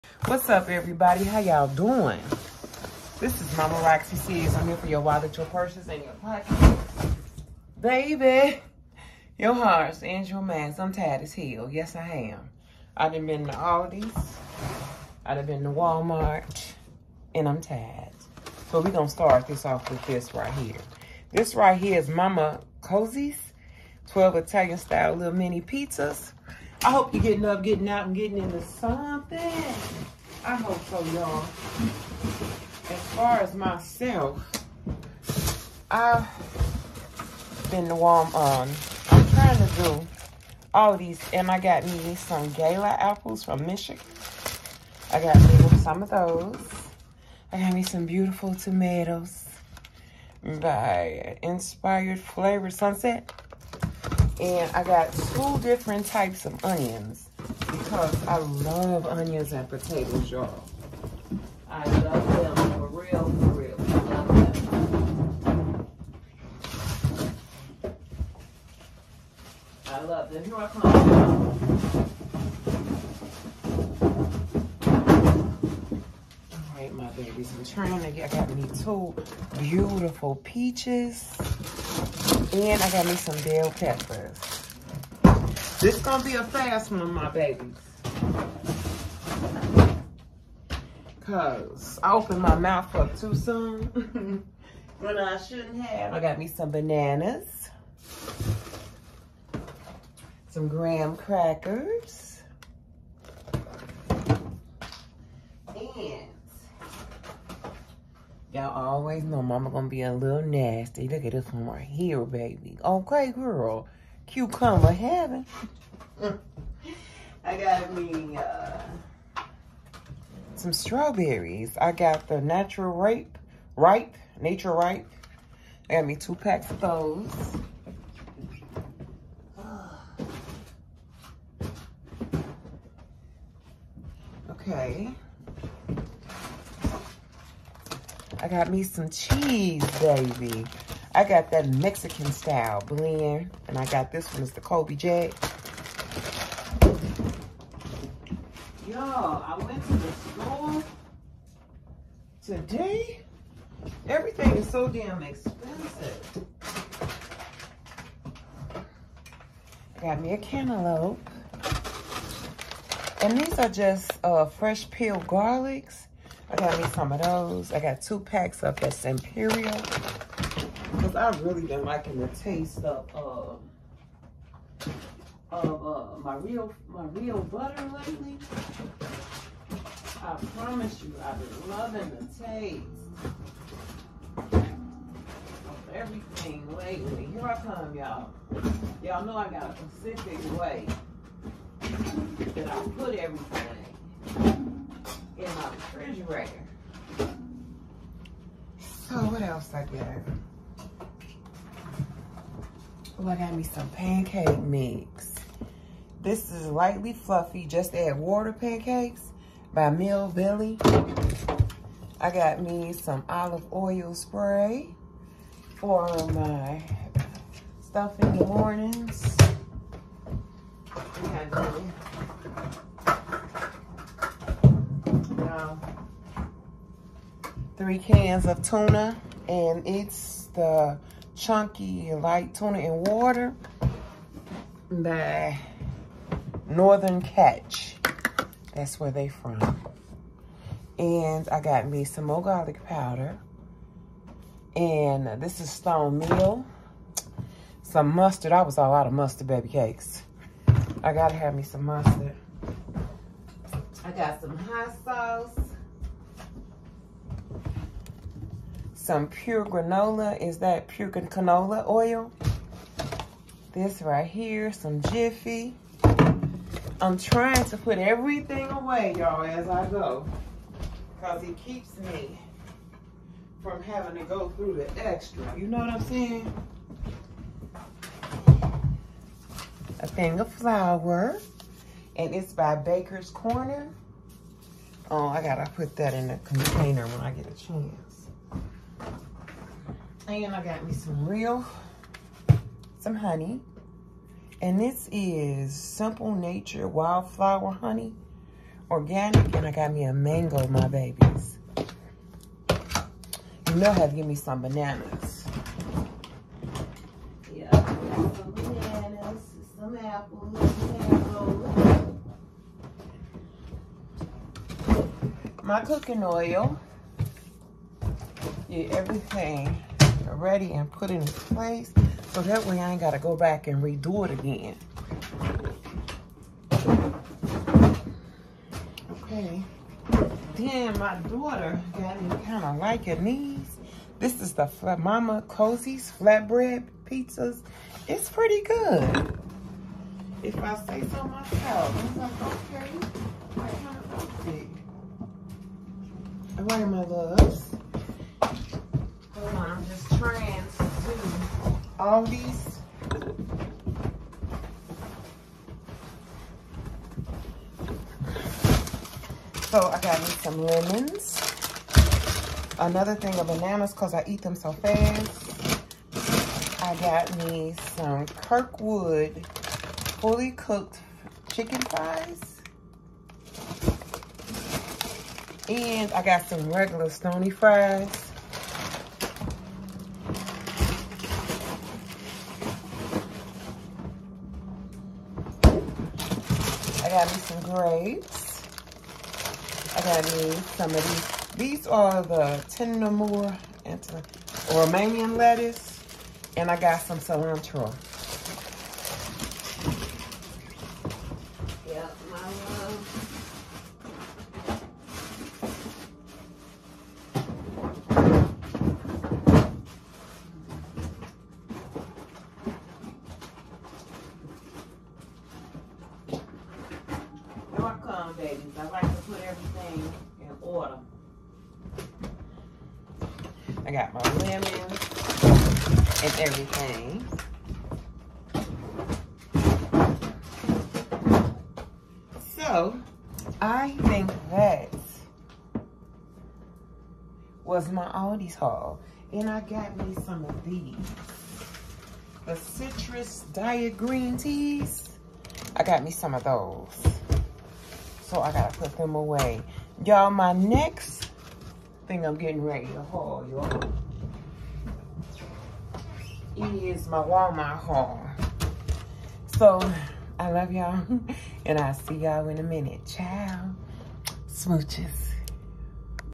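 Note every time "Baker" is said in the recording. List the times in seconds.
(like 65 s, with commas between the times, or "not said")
282 s.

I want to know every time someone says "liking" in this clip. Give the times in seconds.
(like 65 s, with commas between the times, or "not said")
171 s, 333 s.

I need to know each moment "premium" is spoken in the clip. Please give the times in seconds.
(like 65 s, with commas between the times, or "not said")
not said.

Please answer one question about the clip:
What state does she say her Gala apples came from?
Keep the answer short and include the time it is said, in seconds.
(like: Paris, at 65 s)
Michigan, at 43 s.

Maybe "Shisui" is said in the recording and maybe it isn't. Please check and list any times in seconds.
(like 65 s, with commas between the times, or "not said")
not said.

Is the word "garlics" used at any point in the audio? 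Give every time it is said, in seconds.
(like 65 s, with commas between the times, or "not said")
165 s, 242 s.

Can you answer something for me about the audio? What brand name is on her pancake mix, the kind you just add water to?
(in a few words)
Mill Billy.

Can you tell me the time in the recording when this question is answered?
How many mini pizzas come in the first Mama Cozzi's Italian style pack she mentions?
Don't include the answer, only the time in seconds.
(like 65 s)
24 s.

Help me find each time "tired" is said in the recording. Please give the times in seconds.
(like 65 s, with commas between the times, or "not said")
10 s, 17 s.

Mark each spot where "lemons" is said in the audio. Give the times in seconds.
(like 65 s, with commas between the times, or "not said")
360 s, 424 s.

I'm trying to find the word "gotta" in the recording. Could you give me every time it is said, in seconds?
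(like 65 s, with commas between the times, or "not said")
251 s, 285 s, 323 s, 448 s.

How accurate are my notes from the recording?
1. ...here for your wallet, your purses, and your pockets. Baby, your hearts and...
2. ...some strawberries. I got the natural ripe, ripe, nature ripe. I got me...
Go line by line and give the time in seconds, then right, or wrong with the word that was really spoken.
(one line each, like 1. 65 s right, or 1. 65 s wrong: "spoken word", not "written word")
1. 4 s right
2. 120 s right.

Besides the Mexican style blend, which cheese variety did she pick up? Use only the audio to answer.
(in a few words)
Colby Jack.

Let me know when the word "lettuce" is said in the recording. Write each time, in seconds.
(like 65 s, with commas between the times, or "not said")
395 s.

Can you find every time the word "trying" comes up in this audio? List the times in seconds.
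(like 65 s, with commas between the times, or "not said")
39 s, 77 s, 267 s, 350 s.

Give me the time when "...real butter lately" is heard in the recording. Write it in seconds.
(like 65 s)
177 s.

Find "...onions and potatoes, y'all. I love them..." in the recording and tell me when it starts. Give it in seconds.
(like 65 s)
59 s.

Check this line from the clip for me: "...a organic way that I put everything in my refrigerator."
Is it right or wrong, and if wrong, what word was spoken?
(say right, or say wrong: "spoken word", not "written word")
wrong: "specific", not "organic".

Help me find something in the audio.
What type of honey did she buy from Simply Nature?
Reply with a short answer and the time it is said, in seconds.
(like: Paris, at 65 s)
Wildflower, at 296 s.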